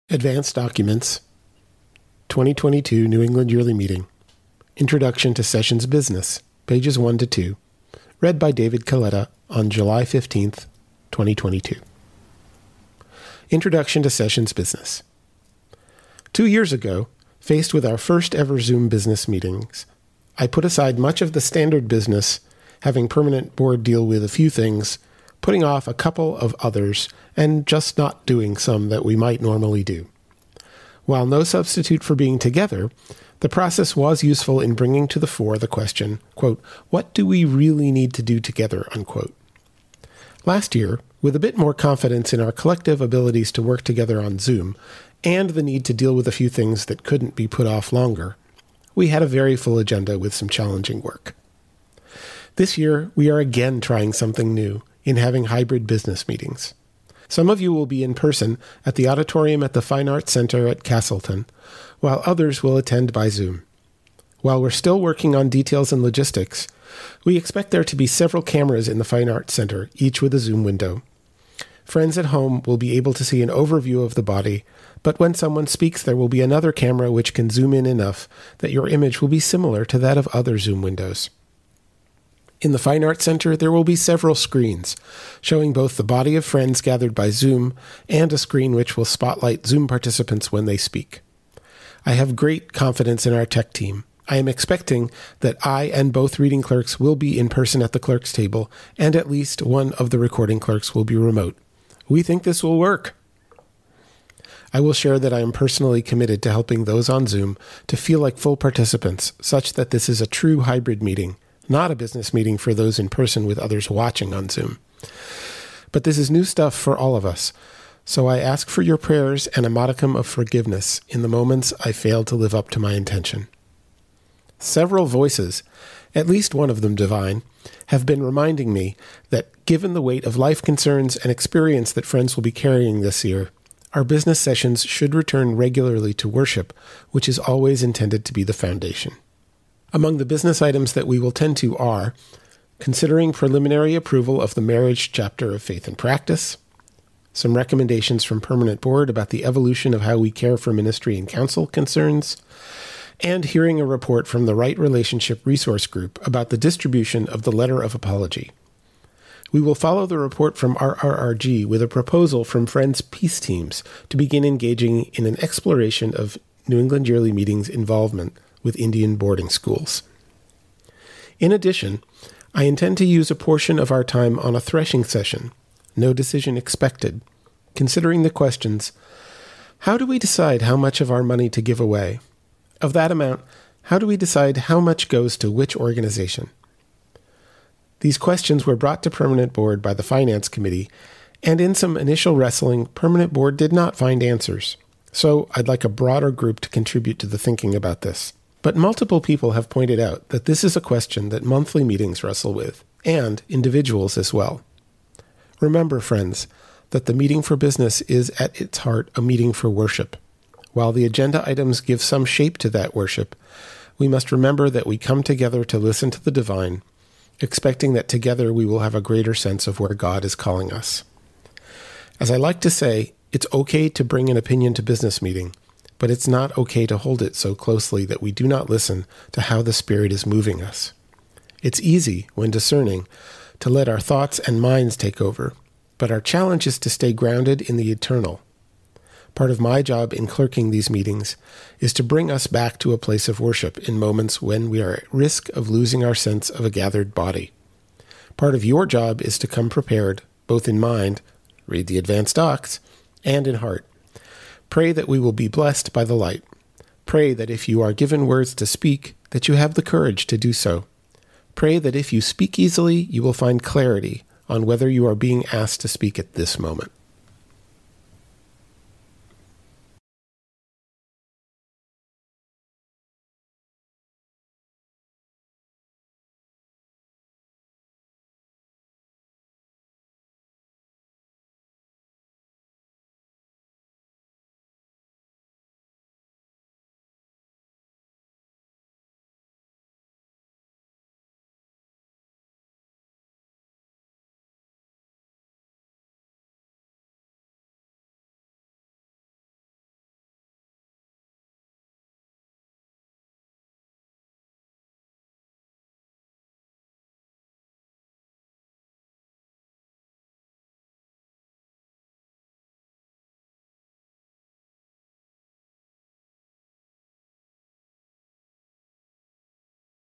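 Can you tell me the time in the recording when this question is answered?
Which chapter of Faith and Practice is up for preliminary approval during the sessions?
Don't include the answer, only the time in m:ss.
2:24.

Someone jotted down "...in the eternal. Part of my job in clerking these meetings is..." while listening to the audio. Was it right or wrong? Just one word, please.
right.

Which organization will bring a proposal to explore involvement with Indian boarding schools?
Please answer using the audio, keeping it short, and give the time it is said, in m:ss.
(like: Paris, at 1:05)
Friends Peace Teams, at 2:42.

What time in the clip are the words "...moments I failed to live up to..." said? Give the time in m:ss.
2:01.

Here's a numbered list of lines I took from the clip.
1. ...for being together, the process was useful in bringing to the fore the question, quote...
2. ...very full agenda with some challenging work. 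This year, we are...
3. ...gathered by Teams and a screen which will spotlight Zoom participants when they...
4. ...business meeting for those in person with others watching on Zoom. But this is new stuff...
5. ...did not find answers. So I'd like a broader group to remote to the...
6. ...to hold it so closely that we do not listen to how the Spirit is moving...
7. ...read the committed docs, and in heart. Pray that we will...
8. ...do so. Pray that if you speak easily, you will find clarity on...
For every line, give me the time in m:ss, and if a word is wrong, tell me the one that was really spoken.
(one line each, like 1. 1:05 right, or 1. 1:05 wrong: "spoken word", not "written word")
1. 0:32 right
2. 0:49 right
3. 1:26 wrong: "Zoom", not "Teams"
4. 1:51 right
5. 3:13 wrong: "contribute", not "remote"
6. 3:46 right
7. 4:11 wrong: "advanced", not "committed"
8. 4:20 right.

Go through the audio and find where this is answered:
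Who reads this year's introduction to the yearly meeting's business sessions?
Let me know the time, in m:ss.
0:08.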